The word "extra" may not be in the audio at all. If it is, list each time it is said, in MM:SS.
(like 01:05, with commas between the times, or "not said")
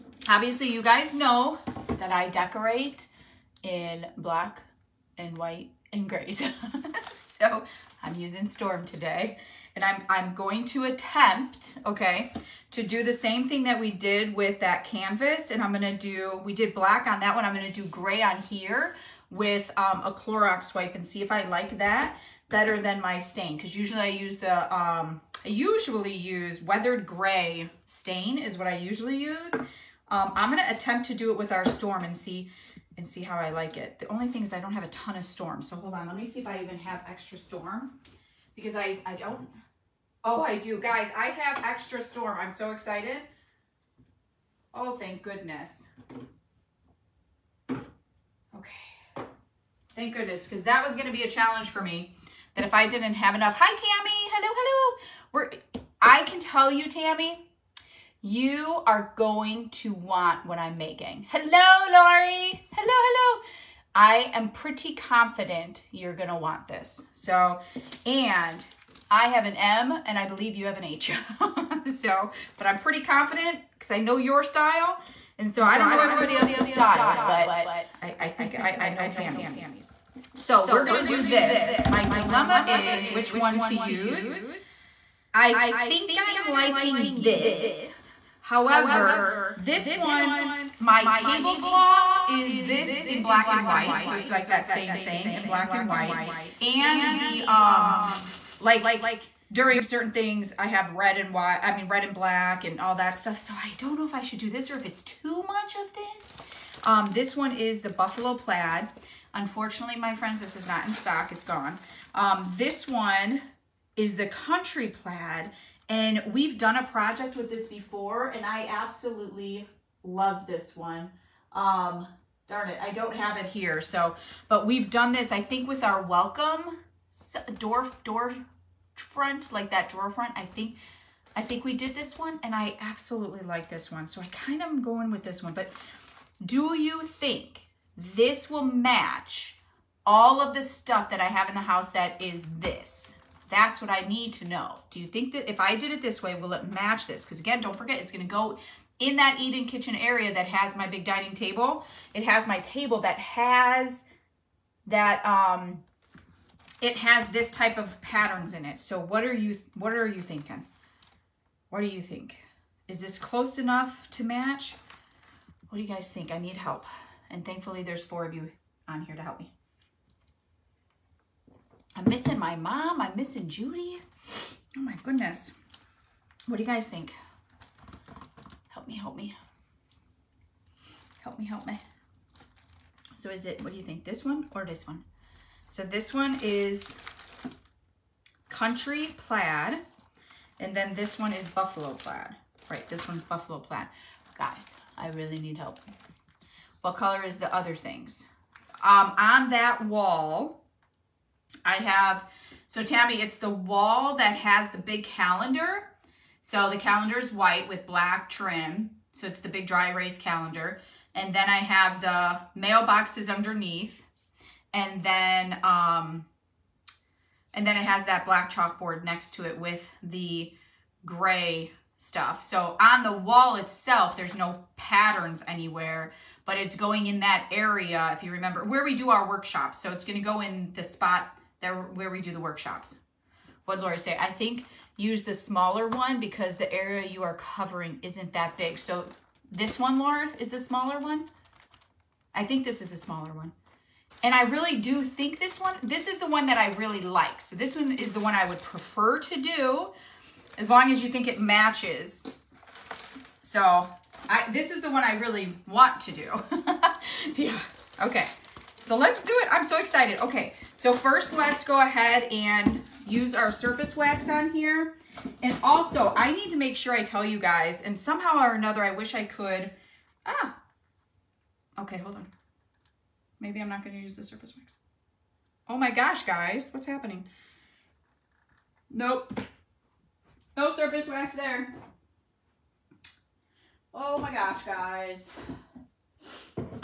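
00:37, 00:41.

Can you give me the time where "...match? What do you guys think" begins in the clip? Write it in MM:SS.
02:44.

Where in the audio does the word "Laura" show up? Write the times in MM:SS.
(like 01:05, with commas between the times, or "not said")
03:53, 03:59.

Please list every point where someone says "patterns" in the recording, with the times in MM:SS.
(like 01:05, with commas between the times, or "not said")
02:38, 03:44.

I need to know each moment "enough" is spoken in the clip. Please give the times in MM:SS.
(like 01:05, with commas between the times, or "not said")
00:53, 02:43.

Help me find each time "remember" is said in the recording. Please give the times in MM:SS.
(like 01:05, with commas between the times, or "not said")
03:48.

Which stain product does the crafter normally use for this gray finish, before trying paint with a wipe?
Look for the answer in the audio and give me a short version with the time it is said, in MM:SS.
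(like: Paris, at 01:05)
weathered gray stain, at 00:26.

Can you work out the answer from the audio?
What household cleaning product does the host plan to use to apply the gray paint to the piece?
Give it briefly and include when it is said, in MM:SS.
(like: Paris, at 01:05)
Clorox wipe, at 00:20.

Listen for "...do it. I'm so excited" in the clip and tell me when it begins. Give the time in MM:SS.
04:19.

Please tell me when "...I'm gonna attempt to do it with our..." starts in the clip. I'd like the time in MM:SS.
00:30.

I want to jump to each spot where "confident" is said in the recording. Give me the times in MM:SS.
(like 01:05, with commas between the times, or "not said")
01:04, 01:13.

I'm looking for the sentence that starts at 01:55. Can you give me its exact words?
And we've done a project with this before, and I absolutely love this one.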